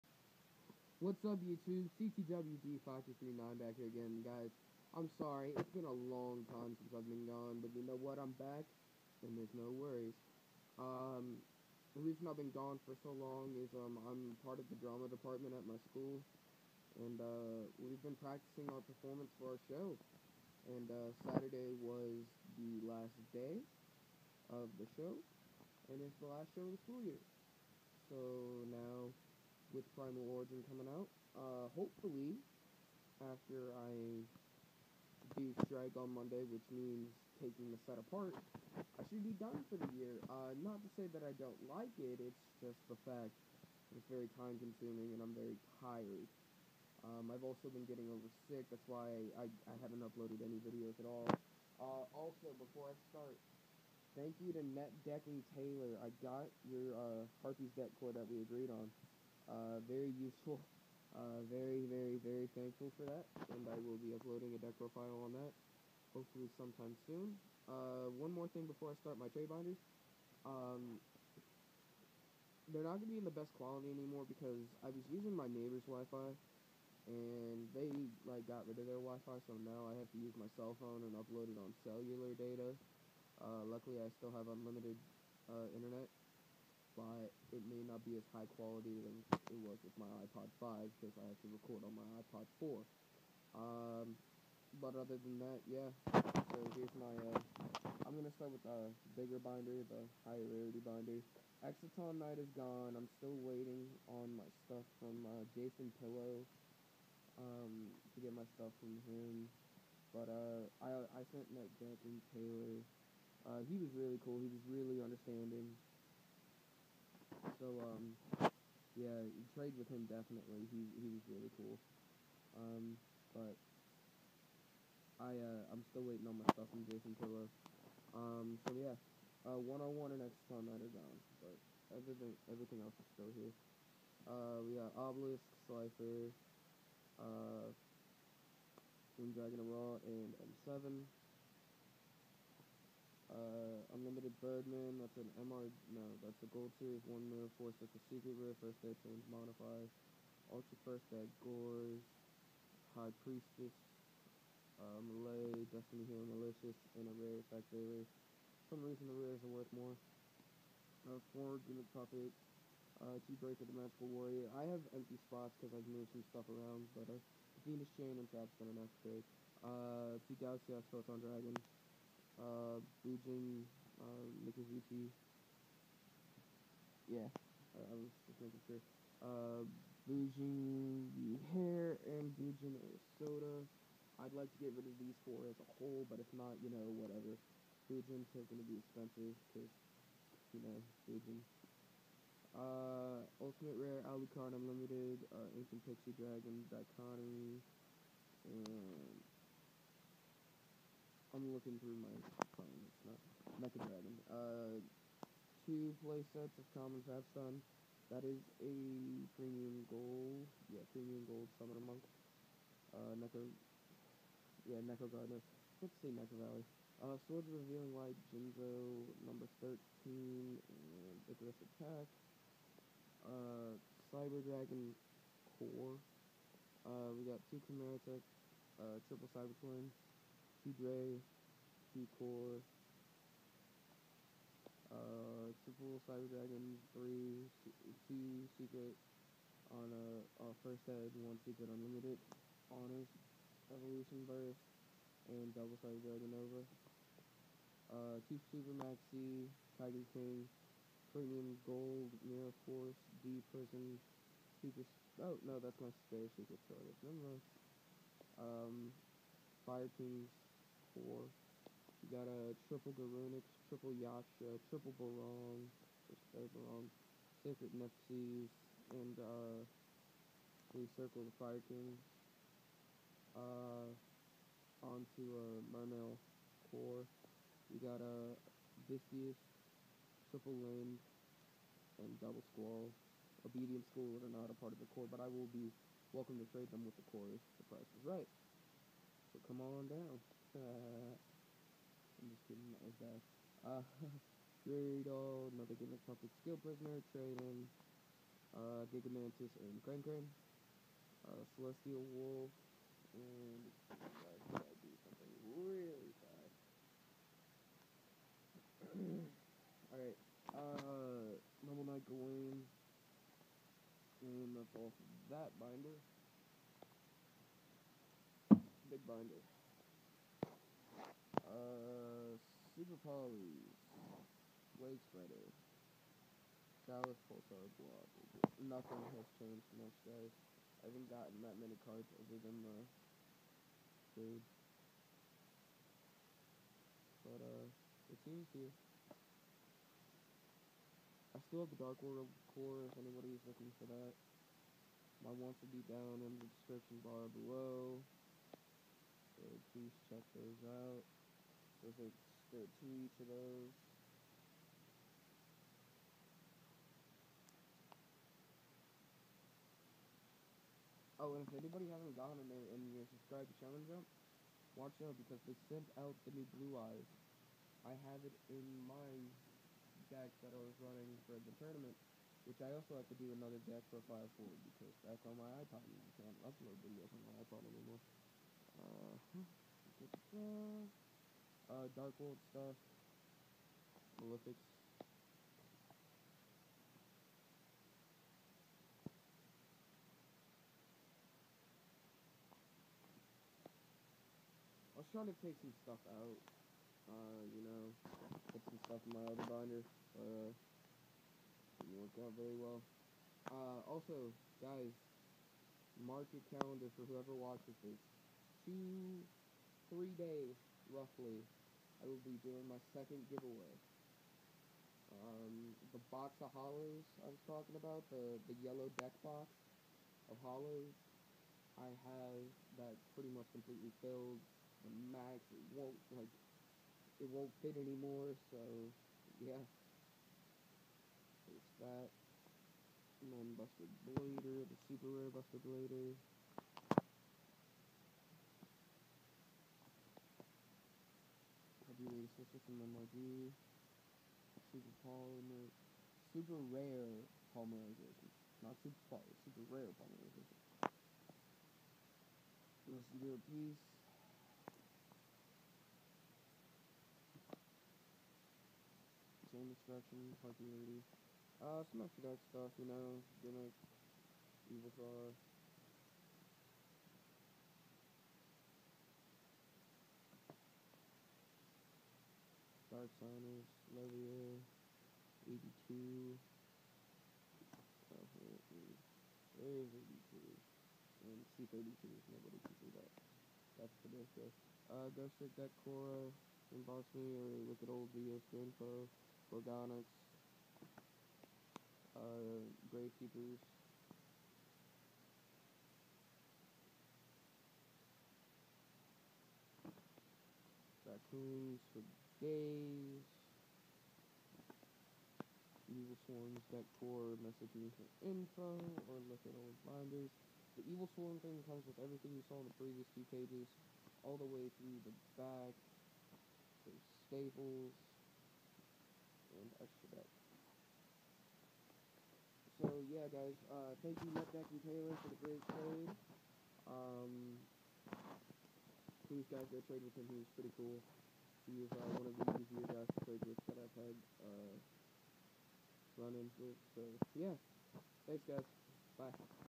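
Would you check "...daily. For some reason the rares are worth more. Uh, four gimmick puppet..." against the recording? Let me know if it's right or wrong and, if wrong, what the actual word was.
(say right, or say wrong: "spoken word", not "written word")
right.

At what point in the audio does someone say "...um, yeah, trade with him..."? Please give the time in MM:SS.
01:57.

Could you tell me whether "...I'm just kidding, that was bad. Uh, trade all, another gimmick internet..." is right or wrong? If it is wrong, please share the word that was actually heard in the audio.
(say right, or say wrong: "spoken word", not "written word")
wrong: "puppet", not "internet".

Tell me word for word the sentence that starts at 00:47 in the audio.
Um, I've also been getting over sick, that's why I, I haven't uploaded any videos at all.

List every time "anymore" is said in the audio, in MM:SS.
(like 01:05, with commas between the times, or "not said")
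01:13, 06:17, 07:07.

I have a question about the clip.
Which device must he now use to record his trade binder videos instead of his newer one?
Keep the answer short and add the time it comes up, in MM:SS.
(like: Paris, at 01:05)
iPod 4, at 01:32.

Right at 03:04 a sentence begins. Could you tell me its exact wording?
I'd like to get rid of these four as a whole, but if not, you know, whatever.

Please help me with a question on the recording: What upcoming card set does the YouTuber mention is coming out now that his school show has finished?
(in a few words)
Primal Origin.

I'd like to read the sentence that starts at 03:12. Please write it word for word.
Uh, Ultimate Rare, Alucard Unlimited, uh, Ancient Pixie Dragon, Dichotomy, and I'm looking through my phone.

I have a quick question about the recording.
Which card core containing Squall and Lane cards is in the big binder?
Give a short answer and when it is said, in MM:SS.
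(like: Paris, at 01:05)
Mermail, at 04:35.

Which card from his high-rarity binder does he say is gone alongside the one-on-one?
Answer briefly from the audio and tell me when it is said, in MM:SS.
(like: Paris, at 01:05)
Exciton Knight, at 01:41.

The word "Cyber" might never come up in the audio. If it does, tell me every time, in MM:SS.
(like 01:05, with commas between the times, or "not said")
03:44, 03:49, 03:56, 04:05.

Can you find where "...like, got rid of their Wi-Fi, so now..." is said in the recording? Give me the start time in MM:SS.
01:18.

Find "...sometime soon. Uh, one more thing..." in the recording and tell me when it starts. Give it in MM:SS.
01:06.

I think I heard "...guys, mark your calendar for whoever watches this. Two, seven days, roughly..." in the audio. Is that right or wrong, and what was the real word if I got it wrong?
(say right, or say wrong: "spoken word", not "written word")
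wrong: "three", not "seven".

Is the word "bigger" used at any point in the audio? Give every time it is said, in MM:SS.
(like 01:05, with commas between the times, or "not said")
01:39.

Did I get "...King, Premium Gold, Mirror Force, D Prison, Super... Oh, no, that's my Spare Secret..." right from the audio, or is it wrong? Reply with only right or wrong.
right.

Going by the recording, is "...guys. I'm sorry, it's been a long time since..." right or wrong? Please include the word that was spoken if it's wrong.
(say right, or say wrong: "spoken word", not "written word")
right.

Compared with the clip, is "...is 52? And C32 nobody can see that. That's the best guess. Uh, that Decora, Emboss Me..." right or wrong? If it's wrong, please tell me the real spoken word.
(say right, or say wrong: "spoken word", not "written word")
wrong: "82", not "52".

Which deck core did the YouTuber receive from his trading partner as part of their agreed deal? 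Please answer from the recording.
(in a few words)
Harpies.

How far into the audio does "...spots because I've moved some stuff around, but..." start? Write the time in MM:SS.
02:45.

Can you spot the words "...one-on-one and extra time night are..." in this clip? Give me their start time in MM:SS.
02:09.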